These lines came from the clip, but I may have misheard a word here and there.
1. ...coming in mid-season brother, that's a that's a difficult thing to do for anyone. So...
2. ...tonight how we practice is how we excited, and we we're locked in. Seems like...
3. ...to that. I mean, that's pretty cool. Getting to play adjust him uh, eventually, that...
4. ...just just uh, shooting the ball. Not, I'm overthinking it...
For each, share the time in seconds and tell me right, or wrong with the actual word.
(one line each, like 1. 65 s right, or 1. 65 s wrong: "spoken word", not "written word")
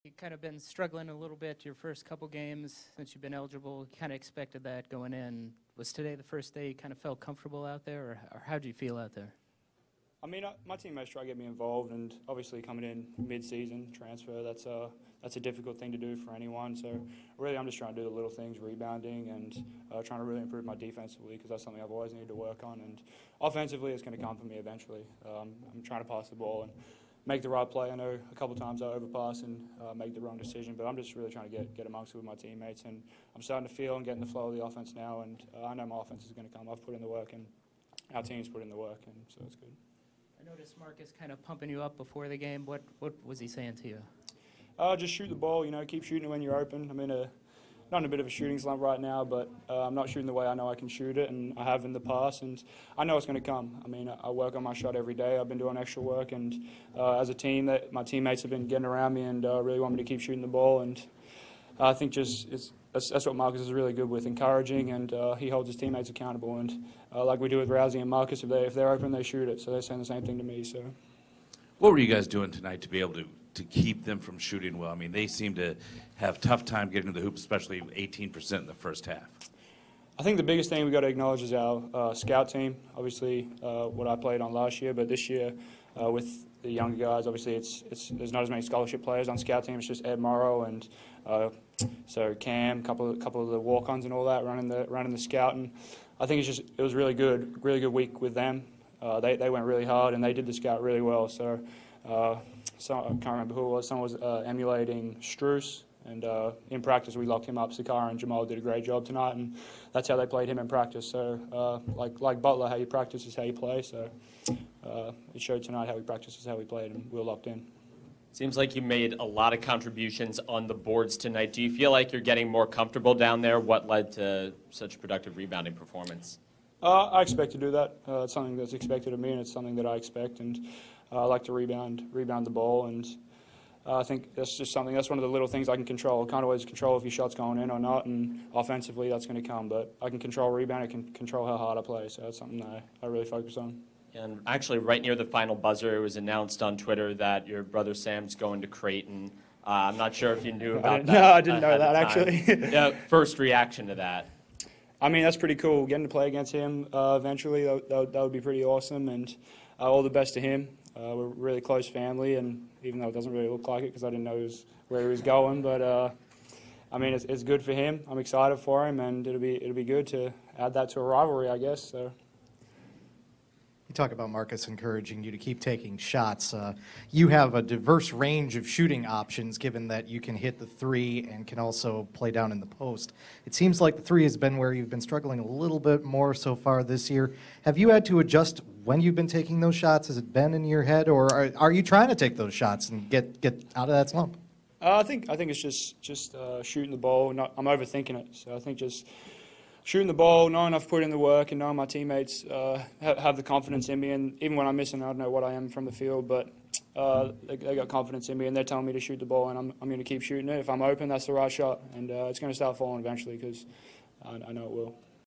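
1. 12 s wrong: "transfer", not "brother"
2. 115 s wrong: "played", not "excited"
3. 153 s wrong: "against", not "adjust"
4. 195 s right.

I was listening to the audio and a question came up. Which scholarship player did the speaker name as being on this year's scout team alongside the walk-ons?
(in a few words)
Ed Morrow.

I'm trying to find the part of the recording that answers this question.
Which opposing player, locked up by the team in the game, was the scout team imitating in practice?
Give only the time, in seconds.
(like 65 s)
105 s.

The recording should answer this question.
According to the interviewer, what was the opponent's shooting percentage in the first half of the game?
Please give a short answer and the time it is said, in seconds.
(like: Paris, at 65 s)
18%, at 77 s.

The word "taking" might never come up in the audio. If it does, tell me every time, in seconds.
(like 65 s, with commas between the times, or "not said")
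175 s, 189 s.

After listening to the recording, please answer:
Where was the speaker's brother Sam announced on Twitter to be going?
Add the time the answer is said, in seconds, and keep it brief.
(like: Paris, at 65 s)
Creighton, at 148 s.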